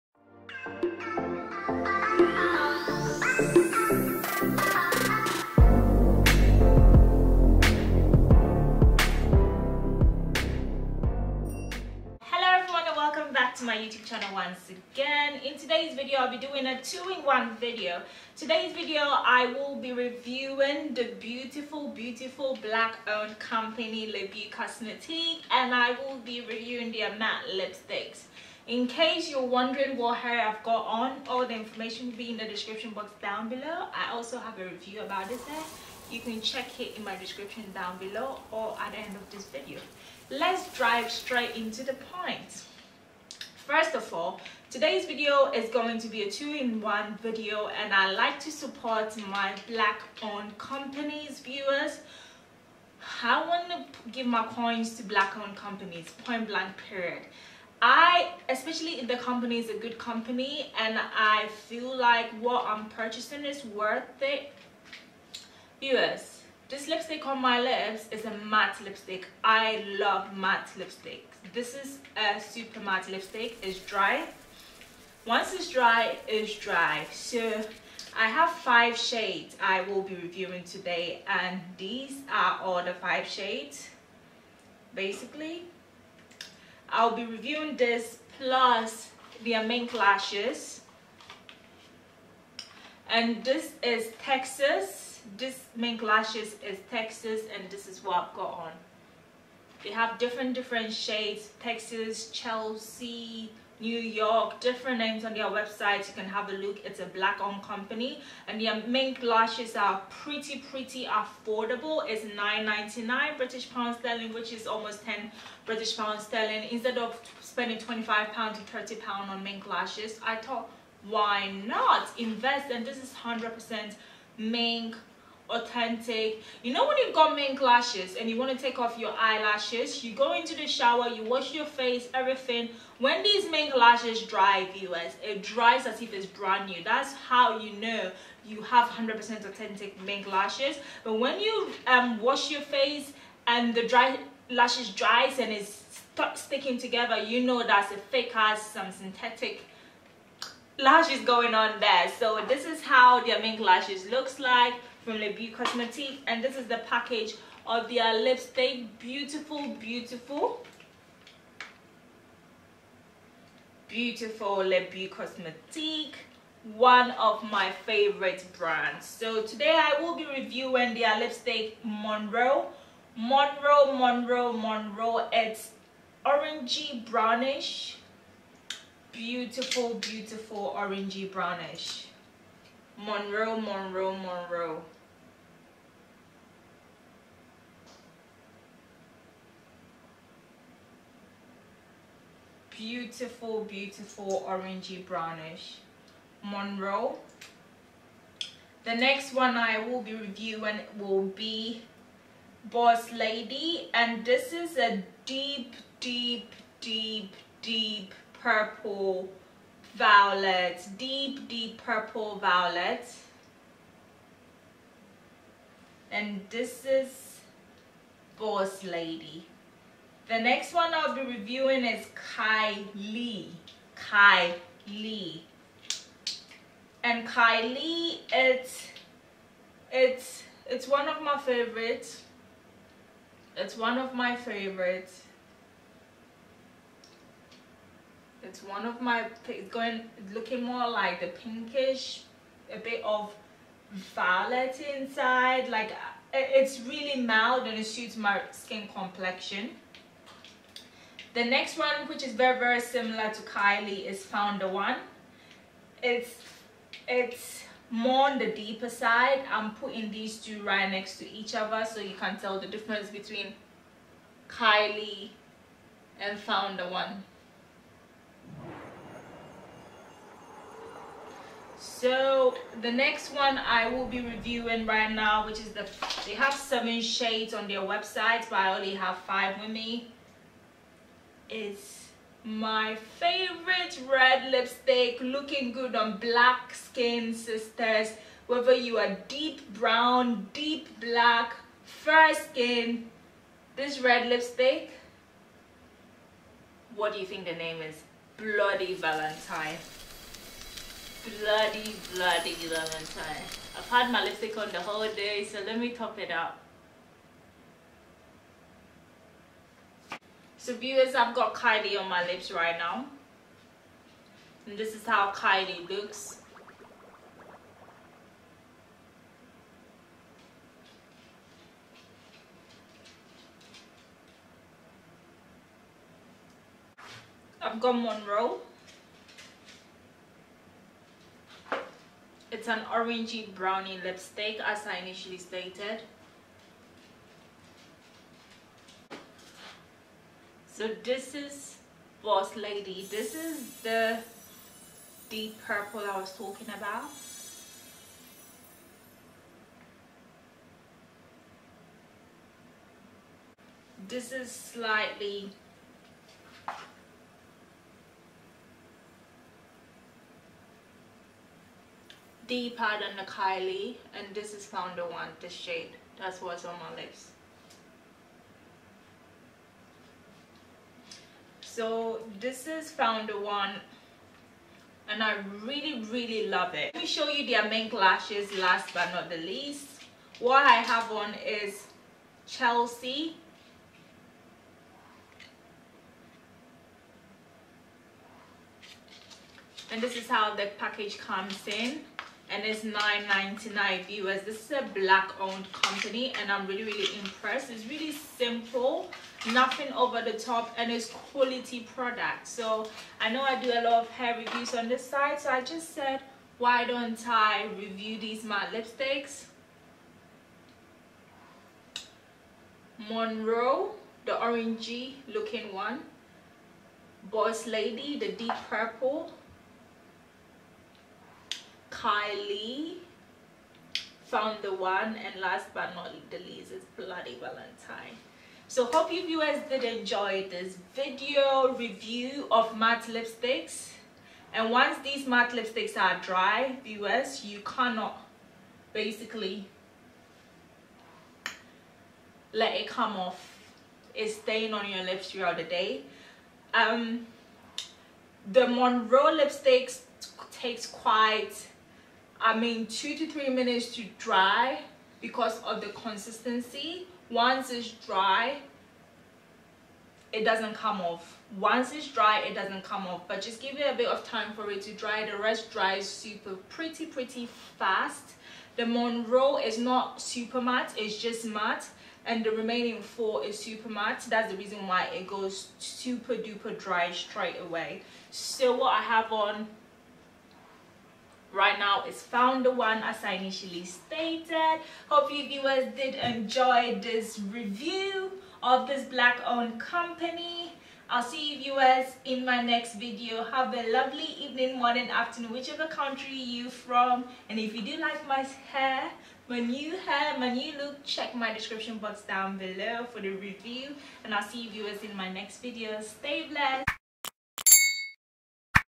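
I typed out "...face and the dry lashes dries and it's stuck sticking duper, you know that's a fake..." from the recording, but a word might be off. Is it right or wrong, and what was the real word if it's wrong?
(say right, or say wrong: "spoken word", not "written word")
wrong: "together", not "duper".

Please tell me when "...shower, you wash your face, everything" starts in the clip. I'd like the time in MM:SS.
02:10.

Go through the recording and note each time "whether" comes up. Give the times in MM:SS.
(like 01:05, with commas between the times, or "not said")
04:48.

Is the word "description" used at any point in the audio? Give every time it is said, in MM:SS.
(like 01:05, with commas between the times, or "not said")
00:32, 00:37, 08:21.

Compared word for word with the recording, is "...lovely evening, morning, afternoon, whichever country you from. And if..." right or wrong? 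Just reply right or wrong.
right.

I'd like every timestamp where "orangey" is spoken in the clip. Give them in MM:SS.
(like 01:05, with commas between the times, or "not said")
02:56, 03:00, 03:14, 05:32, 06:54.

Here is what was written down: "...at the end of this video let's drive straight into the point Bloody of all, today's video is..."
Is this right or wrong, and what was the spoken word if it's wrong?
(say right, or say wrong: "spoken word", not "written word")
wrong: "First", not "Bloody".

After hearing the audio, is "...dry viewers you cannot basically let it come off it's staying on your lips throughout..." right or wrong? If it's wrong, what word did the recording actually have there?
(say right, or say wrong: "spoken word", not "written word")
right.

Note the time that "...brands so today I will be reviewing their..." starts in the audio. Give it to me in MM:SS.
02:48.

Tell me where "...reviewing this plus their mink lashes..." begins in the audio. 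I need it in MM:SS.
01:27.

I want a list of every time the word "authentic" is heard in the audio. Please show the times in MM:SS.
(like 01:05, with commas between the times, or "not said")
02:05, 02:19.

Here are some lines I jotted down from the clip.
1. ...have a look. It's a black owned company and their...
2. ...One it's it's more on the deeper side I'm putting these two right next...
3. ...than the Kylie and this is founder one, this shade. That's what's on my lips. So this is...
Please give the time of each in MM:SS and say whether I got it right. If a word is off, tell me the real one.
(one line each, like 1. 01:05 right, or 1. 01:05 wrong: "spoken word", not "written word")
1. 01:46 right
2. 04:14 right
3. 06:02 right.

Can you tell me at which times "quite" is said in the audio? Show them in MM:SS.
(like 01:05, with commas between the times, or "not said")
07:30.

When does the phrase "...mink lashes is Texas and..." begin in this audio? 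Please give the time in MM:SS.
01:35.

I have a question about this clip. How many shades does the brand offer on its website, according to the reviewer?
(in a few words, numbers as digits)
7.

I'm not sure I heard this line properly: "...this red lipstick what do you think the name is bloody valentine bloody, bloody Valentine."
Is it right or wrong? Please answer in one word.
right.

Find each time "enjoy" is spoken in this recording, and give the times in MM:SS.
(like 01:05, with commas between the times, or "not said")
07:09, 08:06.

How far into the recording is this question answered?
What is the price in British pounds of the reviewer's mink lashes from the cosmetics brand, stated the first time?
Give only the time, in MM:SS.
01:52.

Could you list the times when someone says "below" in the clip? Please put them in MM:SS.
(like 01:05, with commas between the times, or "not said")
00:33, 00:37, 08:22.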